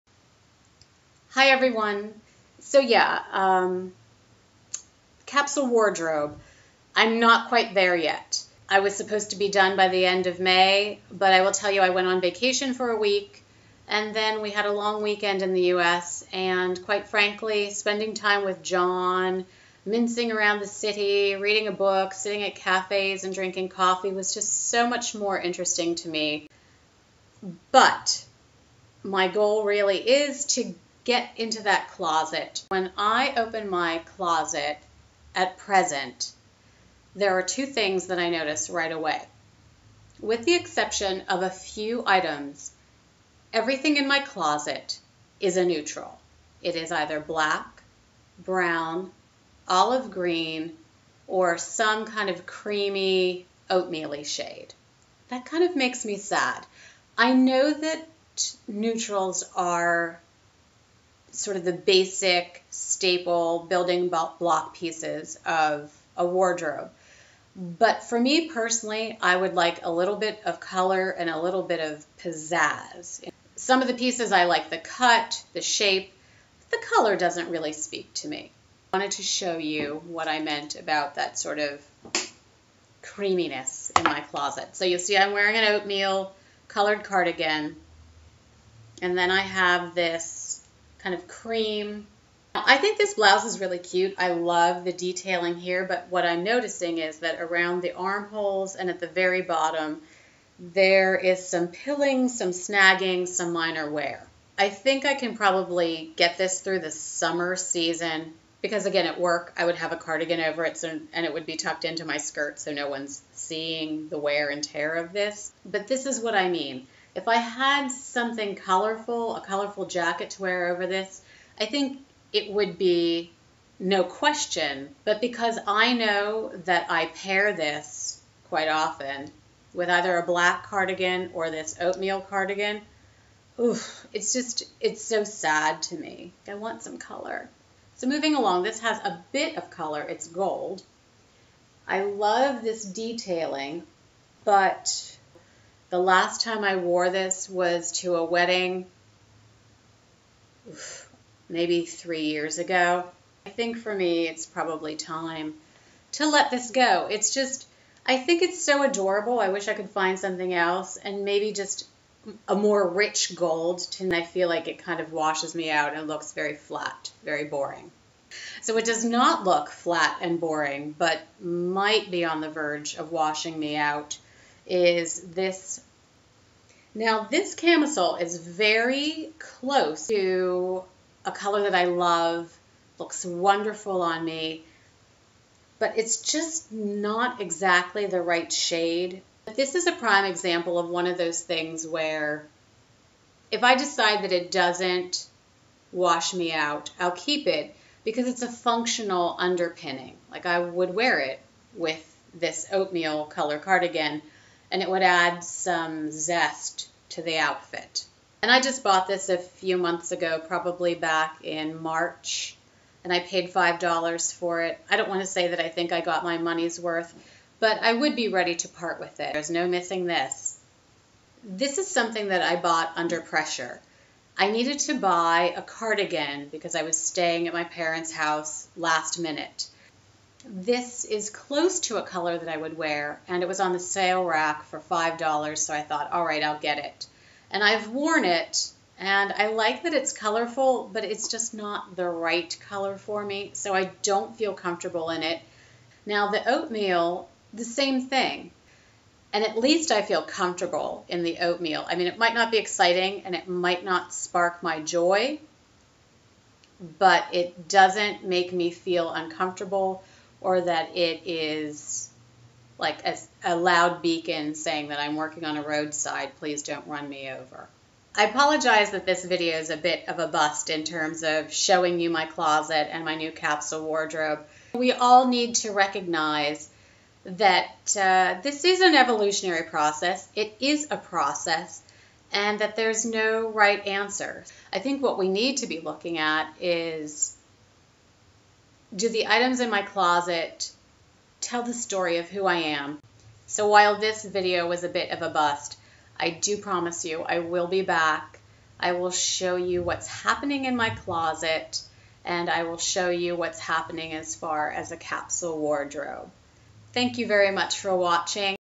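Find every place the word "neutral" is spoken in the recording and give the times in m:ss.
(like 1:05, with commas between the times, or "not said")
0:45, 0:58.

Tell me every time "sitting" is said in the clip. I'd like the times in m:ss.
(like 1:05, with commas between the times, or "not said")
0:22.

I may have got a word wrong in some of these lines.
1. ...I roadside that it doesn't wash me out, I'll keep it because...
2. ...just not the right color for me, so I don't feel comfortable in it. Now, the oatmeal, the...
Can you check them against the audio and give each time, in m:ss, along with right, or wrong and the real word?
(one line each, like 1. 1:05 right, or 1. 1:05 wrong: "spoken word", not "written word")
1. 3:13 wrong: "decide", not "roadside"
2. 4:01 right.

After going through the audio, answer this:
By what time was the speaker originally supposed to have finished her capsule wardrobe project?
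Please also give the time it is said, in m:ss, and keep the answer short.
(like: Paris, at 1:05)
end of May, at 0:10.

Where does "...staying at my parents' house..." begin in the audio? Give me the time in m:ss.
3:46.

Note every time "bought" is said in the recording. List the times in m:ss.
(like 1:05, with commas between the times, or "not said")
3:28, 3:42.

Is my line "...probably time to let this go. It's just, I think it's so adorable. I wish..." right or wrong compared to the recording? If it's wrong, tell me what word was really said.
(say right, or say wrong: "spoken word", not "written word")
right.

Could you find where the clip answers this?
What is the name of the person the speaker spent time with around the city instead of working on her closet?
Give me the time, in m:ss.
0:18.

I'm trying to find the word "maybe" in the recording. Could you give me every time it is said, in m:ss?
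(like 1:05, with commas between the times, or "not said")
2:31, 2:41.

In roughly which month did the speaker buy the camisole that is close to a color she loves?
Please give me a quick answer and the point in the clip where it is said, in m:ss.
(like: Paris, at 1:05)
March, at 3:31.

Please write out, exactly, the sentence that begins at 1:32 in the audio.
I think this blouse is really cute.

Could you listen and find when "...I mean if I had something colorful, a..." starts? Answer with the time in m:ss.
1:56.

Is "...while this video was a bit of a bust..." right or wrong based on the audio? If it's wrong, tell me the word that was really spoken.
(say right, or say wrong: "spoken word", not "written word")
right.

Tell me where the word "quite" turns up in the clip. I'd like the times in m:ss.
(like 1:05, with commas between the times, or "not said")
0:07, 0:16, 2:08.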